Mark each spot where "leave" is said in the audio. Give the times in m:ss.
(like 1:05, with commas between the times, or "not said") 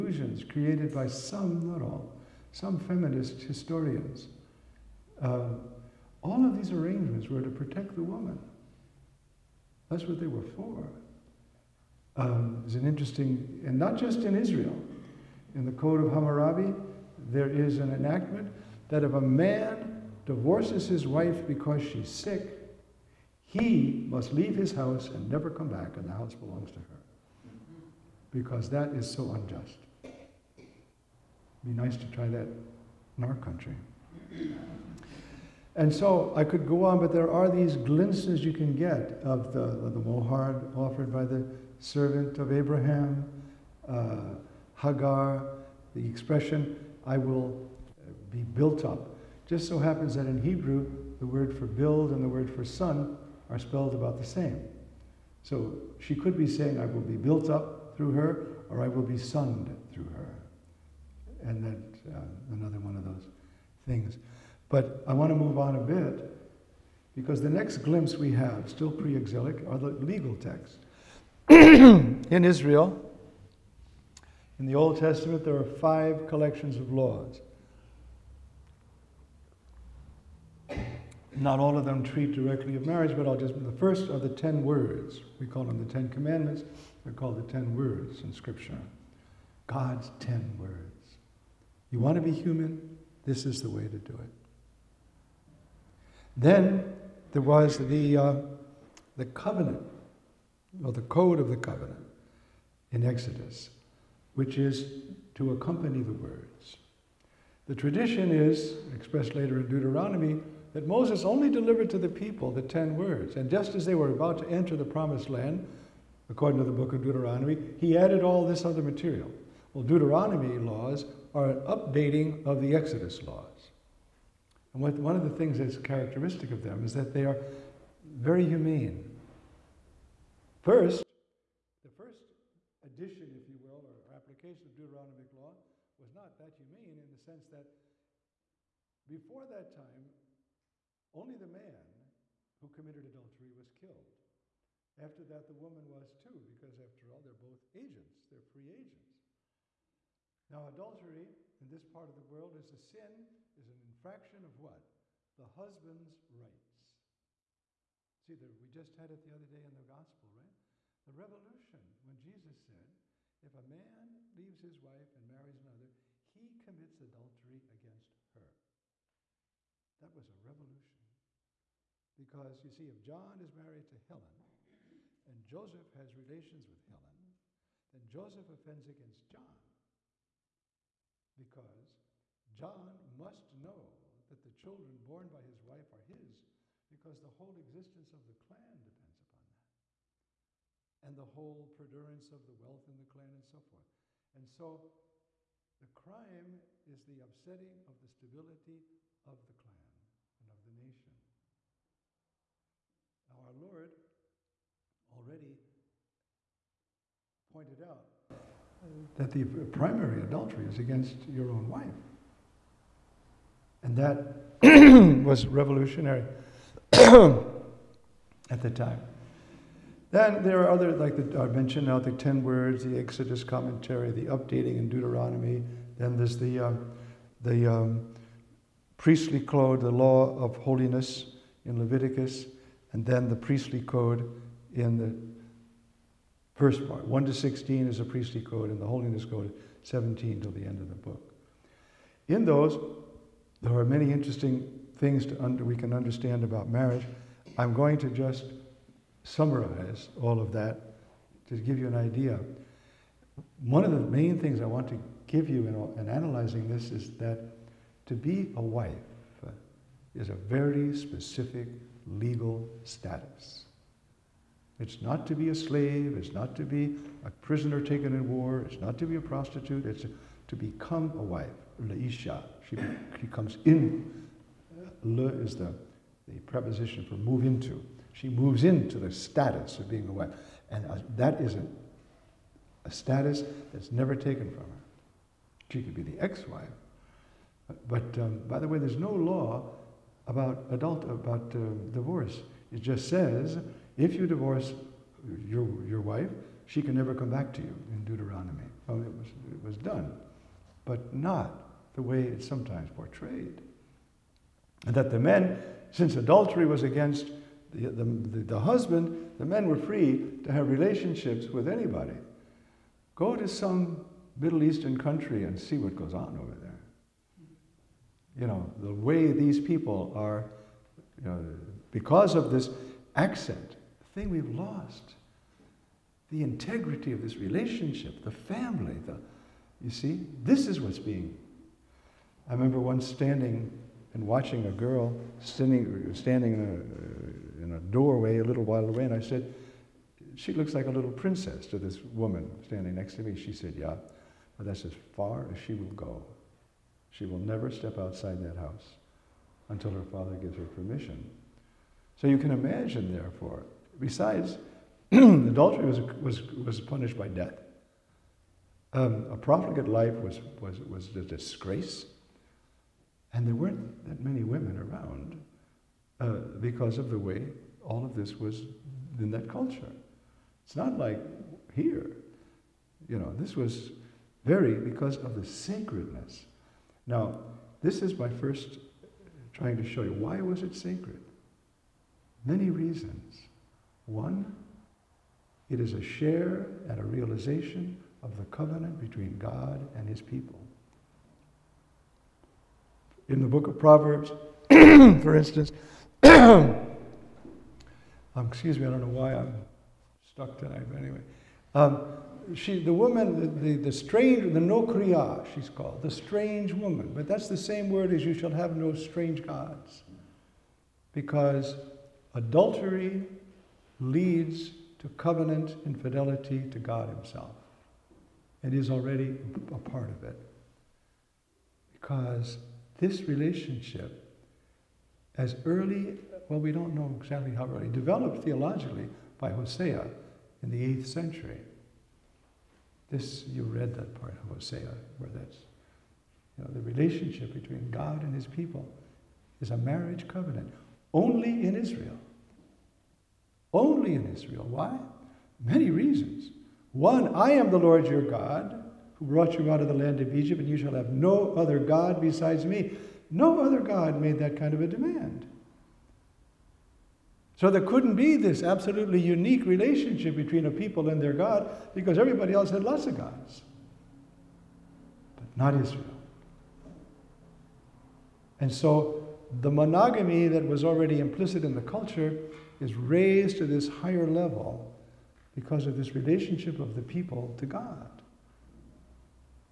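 0:24, 2:44.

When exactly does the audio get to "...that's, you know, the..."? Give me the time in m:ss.
7:15.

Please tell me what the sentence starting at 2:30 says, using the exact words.
Now, adultery in this part of the world is a sin, is an infraction of what?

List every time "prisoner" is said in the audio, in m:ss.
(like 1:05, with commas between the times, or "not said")
4:27.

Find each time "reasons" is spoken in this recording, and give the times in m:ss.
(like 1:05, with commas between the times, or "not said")
6:22, 7:25.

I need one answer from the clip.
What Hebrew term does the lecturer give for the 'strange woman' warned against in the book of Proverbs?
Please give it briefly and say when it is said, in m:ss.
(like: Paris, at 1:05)
nokriya, at 6:44.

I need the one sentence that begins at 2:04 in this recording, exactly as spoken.
And what, one of the things that's characteristic of them is that they are very humane.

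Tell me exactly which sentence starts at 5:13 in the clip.
Go to some Middle Eastern country and see what goes on over there.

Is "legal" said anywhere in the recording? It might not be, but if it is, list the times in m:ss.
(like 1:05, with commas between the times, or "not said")
1:10, 4:22.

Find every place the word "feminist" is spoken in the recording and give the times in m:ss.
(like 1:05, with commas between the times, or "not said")
0:02.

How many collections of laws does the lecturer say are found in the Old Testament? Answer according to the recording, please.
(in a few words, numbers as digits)
5.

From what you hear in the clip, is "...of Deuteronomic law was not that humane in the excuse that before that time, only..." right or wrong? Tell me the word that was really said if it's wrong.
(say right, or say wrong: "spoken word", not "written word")
wrong: "sense", not "excuse".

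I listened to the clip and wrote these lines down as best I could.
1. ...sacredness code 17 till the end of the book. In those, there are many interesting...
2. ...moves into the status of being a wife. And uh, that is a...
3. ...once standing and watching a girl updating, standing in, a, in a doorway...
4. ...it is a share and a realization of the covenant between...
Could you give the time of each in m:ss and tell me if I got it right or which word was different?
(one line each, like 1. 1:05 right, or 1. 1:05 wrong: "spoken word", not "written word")
1. 3:58 wrong: "holiness", not "sacredness"
2. 4:38 right
3. 5:32 wrong: "standing", not "updating"
4. 6:25 right.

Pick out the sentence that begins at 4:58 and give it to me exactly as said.
Well, it was, it was done, but not the way it's sometimes portrayed.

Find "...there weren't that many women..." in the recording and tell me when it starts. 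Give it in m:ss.
6:03.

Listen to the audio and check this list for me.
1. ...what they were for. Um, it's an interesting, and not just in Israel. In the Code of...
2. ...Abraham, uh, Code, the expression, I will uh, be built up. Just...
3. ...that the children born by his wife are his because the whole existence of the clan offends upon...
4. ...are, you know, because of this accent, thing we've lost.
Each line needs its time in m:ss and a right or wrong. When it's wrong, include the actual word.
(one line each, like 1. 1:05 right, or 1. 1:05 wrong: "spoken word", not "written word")
1. 0:10 right
2. 0:42 wrong: "Hagar", not "Code"
3. 3:04 wrong: "depends", not "offends"
4. 5:20 right.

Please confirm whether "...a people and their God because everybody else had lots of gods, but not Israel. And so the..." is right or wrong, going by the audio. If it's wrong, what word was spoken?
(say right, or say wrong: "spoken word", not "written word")
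right.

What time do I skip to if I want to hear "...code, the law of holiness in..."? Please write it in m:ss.
3:49.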